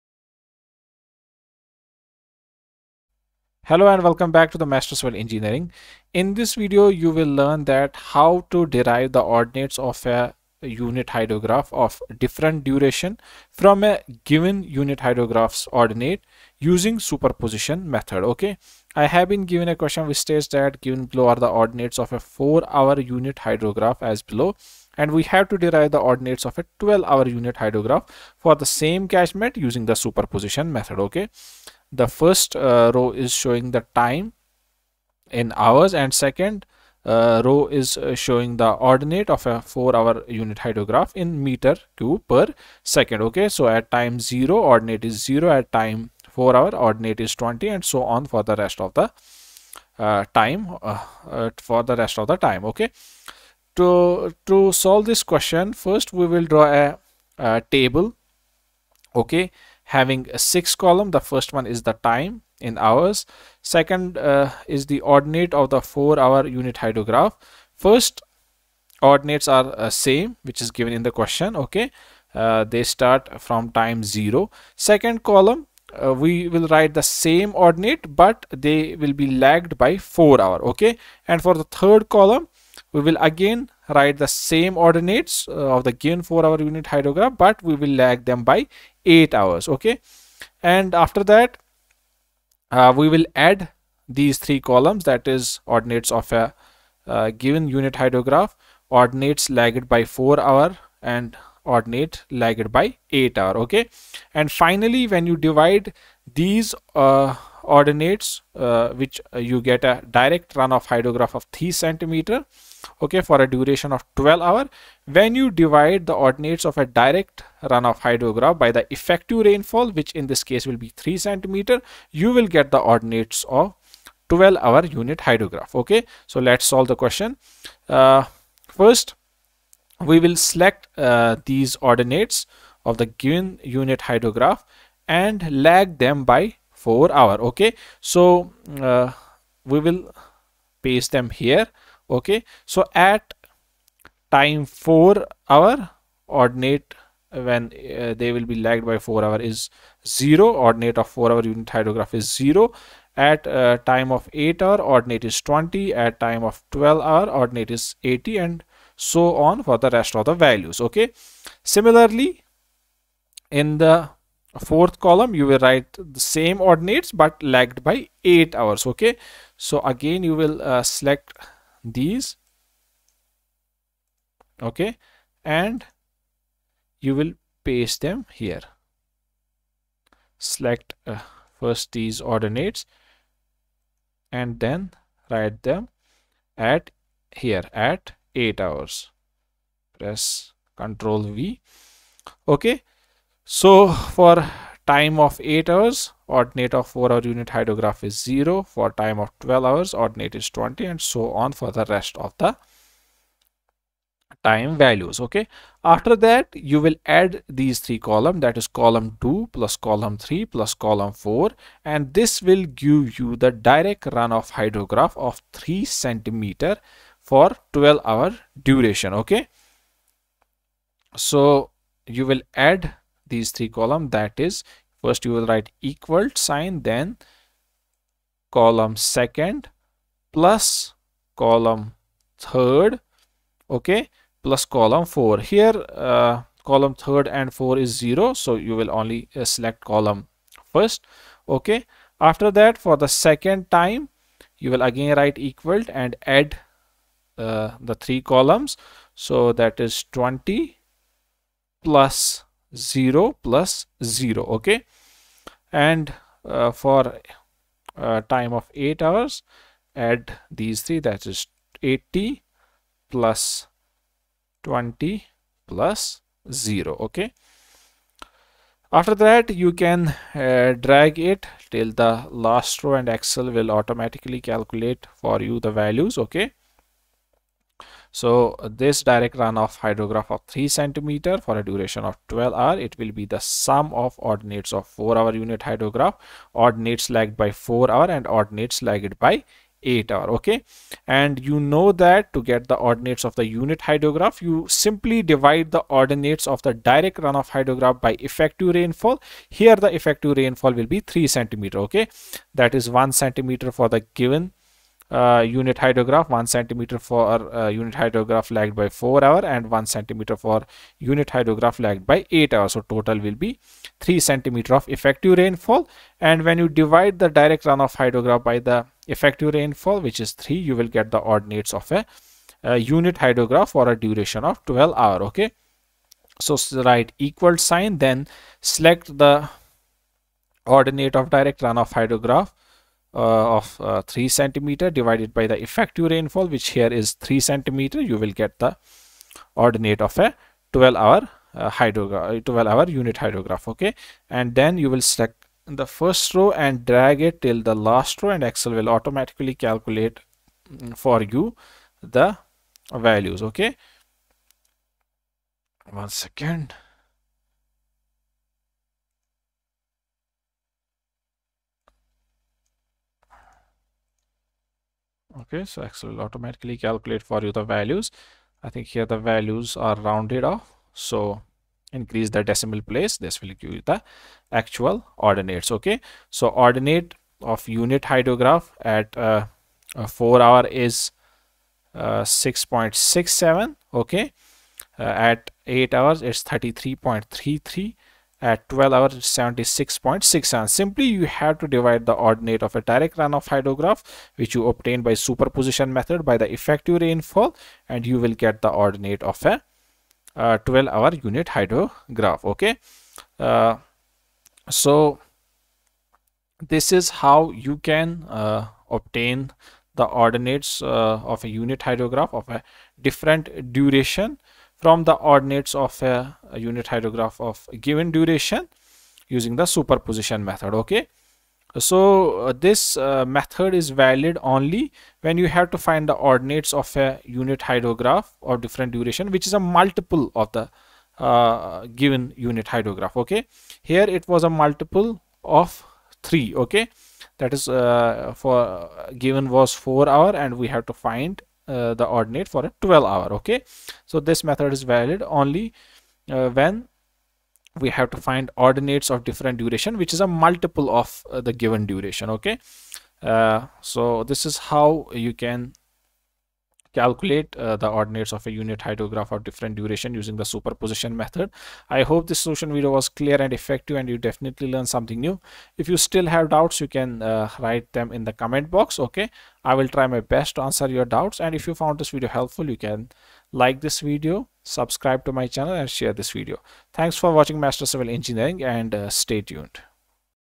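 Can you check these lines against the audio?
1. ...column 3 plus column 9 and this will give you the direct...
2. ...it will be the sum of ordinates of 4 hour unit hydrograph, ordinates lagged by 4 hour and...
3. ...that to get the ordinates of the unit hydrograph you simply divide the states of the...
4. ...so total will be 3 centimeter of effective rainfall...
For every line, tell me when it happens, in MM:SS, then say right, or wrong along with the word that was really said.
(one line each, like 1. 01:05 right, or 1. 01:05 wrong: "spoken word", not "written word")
1. 03:29 wrong: "4", not "9"
2. 04:42 right
3. 04:51 wrong: "ordinates", not "states"
4. 05:12 right.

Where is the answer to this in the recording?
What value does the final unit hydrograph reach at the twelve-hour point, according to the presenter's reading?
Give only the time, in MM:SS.
06:29.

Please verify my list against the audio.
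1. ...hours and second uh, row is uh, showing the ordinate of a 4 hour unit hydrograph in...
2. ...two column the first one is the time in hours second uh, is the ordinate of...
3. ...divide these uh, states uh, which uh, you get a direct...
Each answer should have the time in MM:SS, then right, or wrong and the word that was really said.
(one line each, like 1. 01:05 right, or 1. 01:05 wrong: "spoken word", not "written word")
1. 00:35 right
2. 01:00 wrong: "six", not "two"
3. 01:45 wrong: "ordinates", not "states".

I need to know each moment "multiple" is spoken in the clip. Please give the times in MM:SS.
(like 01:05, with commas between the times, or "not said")
07:09, 07:14, 07:30.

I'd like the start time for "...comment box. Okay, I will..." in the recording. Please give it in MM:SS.
07:48.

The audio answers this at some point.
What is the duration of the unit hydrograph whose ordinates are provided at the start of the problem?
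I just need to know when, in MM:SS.
00:22.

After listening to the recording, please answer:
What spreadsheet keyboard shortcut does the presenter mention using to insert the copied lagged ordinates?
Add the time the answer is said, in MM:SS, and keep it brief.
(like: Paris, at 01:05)
Control V, at 03:10.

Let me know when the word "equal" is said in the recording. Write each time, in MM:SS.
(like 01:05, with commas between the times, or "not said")
03:45, 04:05, 05:27.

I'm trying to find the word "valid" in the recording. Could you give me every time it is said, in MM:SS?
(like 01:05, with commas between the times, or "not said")
07:03, 07:24.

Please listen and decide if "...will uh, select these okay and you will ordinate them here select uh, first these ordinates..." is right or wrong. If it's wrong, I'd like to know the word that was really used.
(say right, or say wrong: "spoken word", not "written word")
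wrong: "paste", not "ordinate".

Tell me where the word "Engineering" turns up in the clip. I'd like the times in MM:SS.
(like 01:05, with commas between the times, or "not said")
00:05, 07:58.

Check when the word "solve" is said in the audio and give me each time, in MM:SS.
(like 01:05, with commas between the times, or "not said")
00:54, 02:06.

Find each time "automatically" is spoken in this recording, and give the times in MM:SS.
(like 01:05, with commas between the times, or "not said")
04:33, 05:48, 06:06.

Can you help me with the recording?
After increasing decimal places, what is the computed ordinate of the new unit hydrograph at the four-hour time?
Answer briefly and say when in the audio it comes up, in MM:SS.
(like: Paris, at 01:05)
6.67, at 06:22.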